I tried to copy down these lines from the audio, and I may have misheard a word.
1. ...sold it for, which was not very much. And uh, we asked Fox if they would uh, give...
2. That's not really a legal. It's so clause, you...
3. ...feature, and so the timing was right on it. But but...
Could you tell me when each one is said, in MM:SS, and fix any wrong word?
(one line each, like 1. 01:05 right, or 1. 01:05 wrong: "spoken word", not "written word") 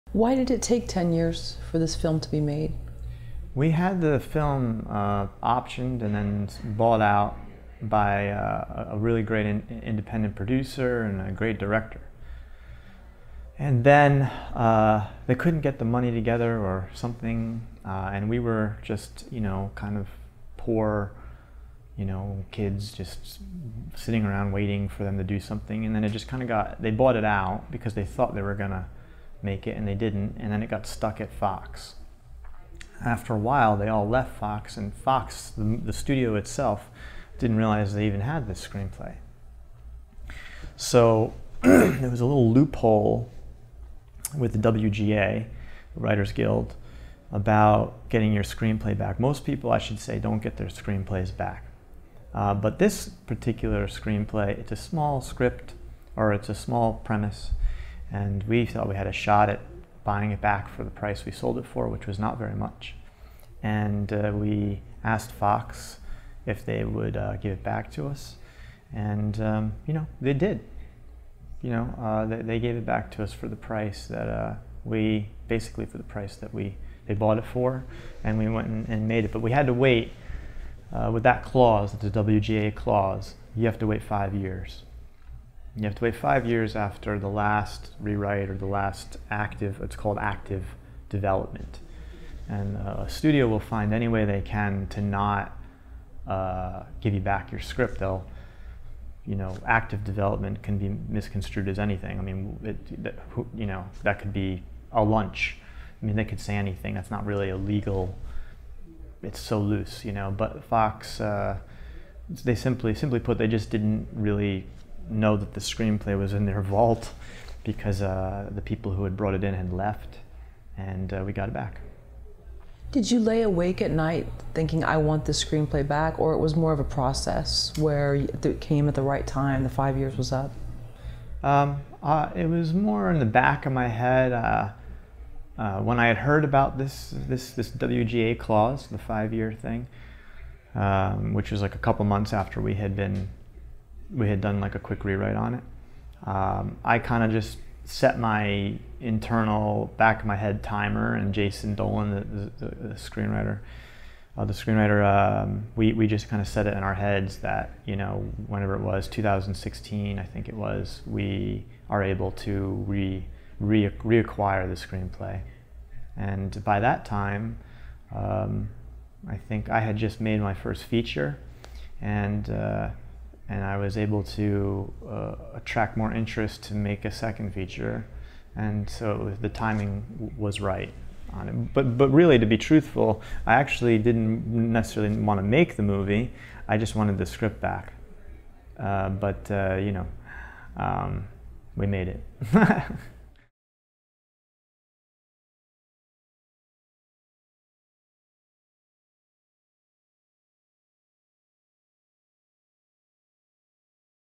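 1. 01:01 right
2. 01:46 wrong: "loose", not "clause"
3. 02:57 right.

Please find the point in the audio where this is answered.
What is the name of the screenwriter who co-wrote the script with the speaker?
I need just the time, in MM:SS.
02:31.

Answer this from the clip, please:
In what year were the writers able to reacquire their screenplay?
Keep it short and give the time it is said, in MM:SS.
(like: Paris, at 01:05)
2016, at 02:39.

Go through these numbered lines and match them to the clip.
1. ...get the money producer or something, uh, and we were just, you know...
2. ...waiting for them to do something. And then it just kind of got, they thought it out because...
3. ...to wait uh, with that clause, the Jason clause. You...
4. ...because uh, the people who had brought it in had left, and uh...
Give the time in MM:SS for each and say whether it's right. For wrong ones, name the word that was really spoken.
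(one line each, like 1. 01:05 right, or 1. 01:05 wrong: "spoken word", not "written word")
1. 00:15 wrong: "together", not "producer"
2. 00:24 wrong: "bought", not "thought"
3. 01:19 wrong: "WGA", not "Jason"
4. 01:57 right.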